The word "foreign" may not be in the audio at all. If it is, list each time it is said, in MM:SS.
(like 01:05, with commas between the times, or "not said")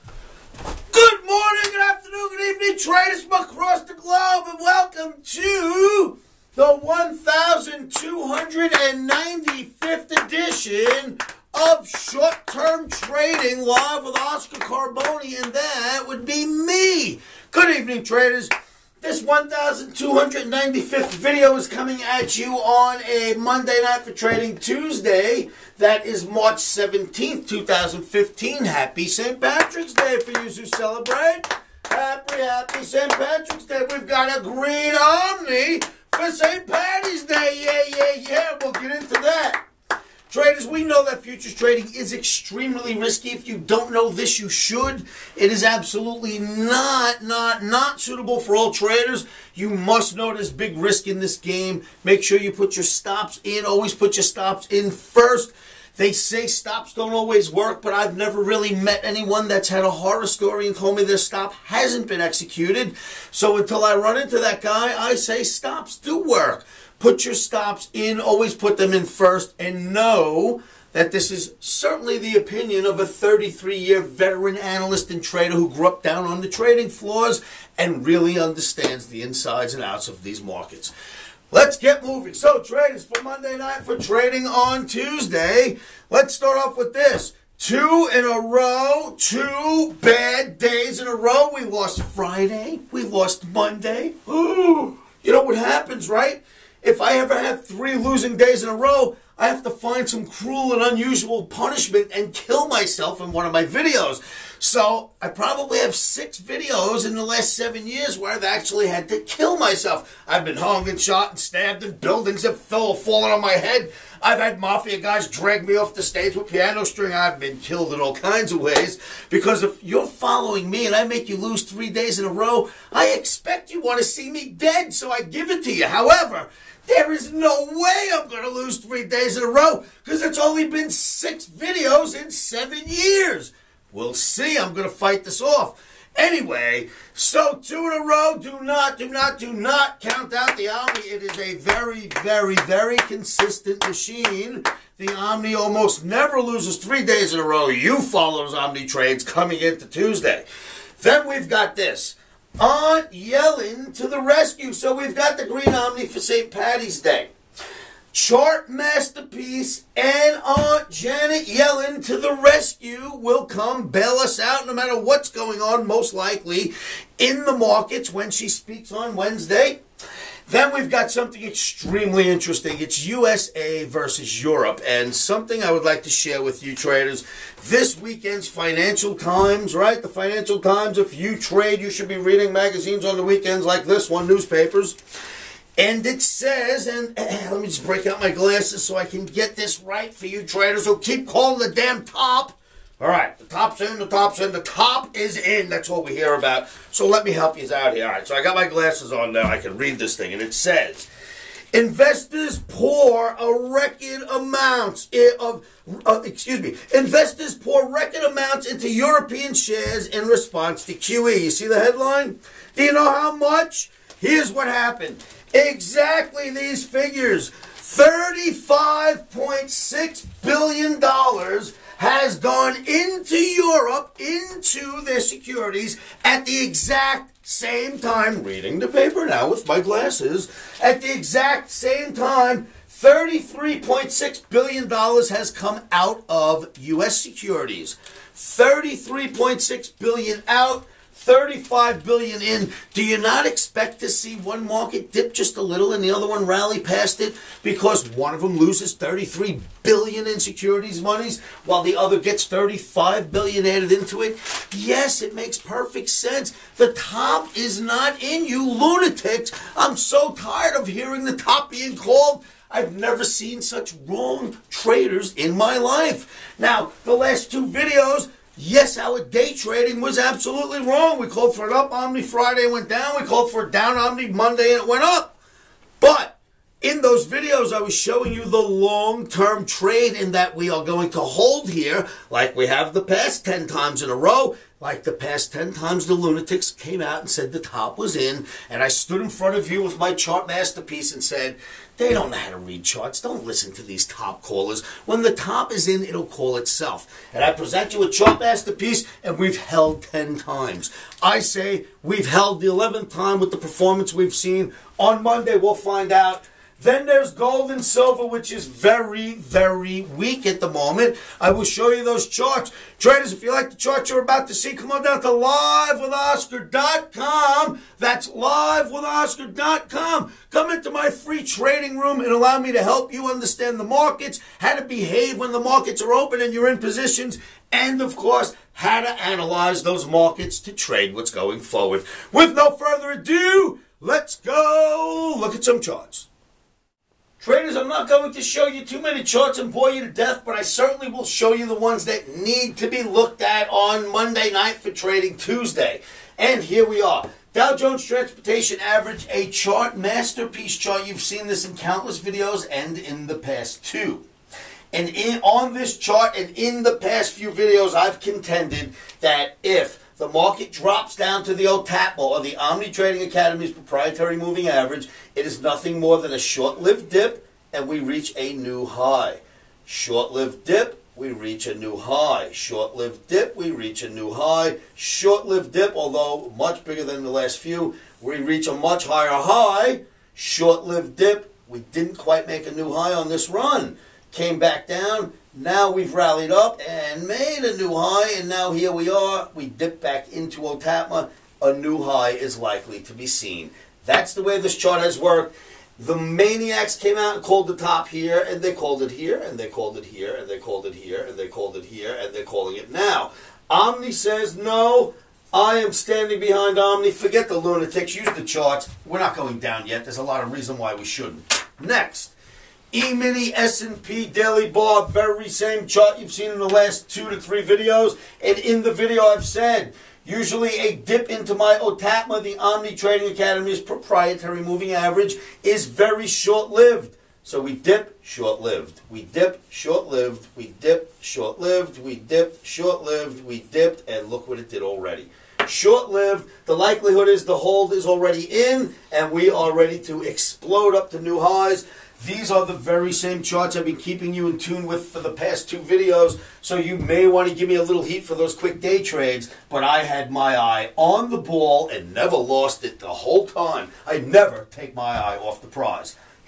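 not said.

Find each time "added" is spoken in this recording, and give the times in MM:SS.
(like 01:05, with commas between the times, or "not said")
04:13.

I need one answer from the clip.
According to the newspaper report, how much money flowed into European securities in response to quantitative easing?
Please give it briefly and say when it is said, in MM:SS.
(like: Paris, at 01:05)
$35.6 billion, at 03:37.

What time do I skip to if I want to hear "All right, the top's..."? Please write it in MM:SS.
03:13.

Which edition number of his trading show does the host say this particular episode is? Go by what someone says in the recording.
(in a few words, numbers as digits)
1,295th.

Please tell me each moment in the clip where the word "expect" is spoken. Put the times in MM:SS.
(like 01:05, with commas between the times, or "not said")
02:03, 04:03.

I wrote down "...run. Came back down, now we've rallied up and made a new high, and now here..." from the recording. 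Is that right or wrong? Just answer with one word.
right.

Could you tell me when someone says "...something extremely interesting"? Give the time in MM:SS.
02:51.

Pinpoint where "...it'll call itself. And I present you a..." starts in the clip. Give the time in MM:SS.
04:56.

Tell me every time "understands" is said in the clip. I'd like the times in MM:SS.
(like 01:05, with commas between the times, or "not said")
01:18, 05:23.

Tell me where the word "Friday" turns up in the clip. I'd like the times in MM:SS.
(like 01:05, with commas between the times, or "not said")
01:32, 04:32.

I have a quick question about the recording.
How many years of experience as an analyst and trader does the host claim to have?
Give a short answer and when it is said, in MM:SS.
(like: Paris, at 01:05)
33, at 01:13.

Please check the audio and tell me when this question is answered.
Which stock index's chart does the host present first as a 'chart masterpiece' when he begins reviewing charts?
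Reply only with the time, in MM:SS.
05:47.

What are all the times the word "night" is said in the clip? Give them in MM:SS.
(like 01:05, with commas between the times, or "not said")
00:23, 01:23, 05:44.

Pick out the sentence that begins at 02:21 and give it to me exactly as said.
It is a very, very, very consistent machine.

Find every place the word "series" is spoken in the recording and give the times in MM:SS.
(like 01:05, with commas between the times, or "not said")
not said.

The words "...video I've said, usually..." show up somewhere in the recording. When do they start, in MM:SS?
06:58.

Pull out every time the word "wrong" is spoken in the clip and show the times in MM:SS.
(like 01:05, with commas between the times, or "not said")
04:24, 04:30.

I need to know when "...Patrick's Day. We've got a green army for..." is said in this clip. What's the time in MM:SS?
00:33.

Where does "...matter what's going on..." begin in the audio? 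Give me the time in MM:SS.
02:44.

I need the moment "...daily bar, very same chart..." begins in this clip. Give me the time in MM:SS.
06:54.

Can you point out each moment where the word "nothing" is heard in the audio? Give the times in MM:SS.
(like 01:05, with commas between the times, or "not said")
06:05.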